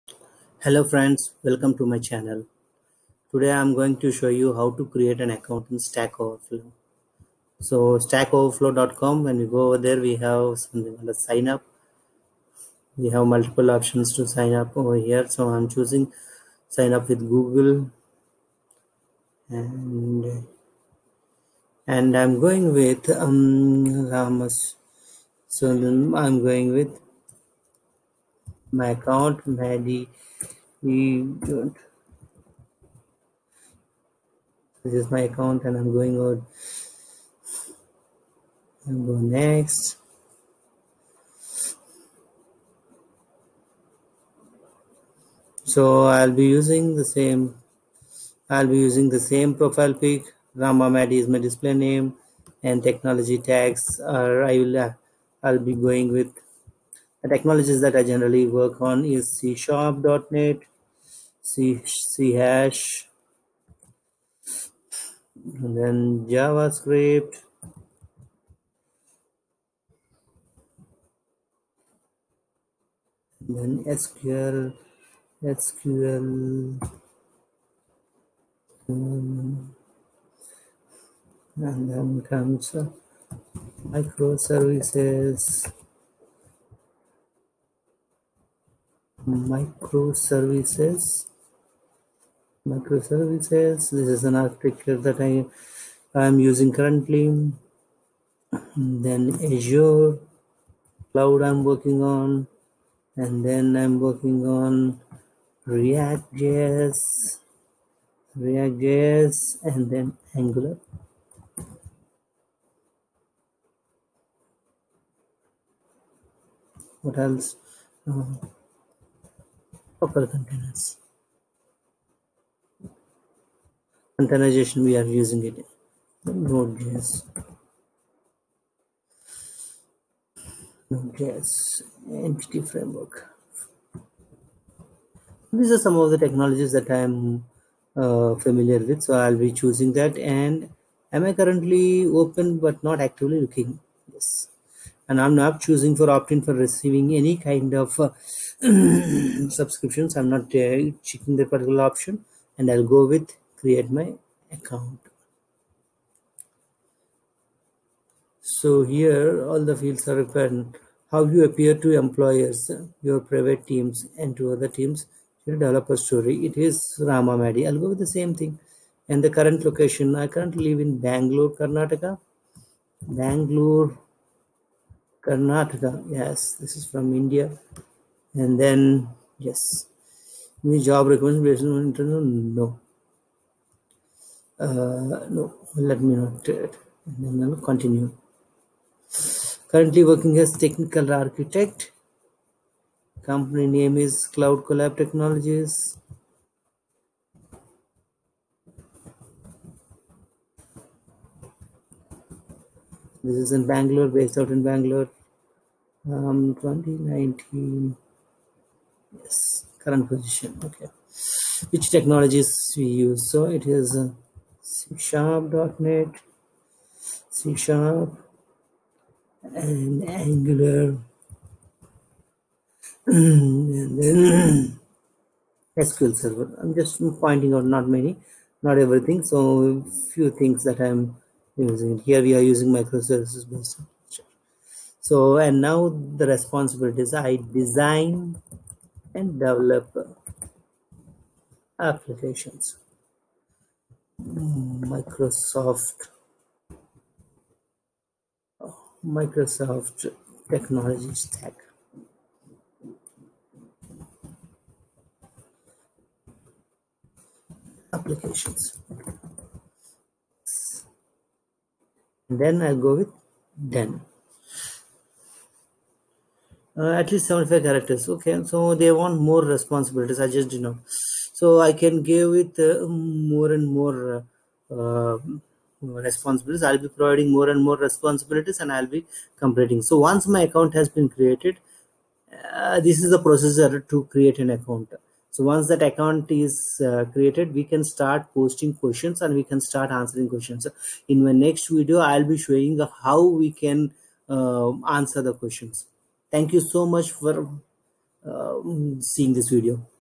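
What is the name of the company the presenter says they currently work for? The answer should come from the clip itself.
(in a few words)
Cloud Collab Technologies.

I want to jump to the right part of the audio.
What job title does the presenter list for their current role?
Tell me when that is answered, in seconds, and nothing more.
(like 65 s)
190 s.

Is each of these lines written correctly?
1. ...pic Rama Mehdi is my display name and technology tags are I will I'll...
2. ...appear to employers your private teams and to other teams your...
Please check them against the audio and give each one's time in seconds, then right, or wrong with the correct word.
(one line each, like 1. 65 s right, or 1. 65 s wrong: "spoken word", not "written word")
1. 49 s right
2. 161 s right.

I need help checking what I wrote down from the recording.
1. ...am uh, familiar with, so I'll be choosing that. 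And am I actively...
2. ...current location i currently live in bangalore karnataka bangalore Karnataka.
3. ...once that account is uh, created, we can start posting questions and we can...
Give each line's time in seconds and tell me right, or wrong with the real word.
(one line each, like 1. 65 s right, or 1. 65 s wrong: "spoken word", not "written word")
1. 137 s wrong: "currently", not "actively"
2. 169 s right
3. 285 s right.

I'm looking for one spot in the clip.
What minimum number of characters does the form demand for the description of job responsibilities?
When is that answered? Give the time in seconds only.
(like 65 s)
267 s.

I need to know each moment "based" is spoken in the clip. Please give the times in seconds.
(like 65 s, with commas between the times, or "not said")
204 s, 233 s.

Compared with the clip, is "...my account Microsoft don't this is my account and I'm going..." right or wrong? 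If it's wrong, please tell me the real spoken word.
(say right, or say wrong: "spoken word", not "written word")
wrong: "Mehdi", not "Microsoft".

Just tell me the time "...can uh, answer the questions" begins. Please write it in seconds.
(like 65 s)
293 s.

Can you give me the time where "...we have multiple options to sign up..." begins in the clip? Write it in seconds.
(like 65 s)
12 s.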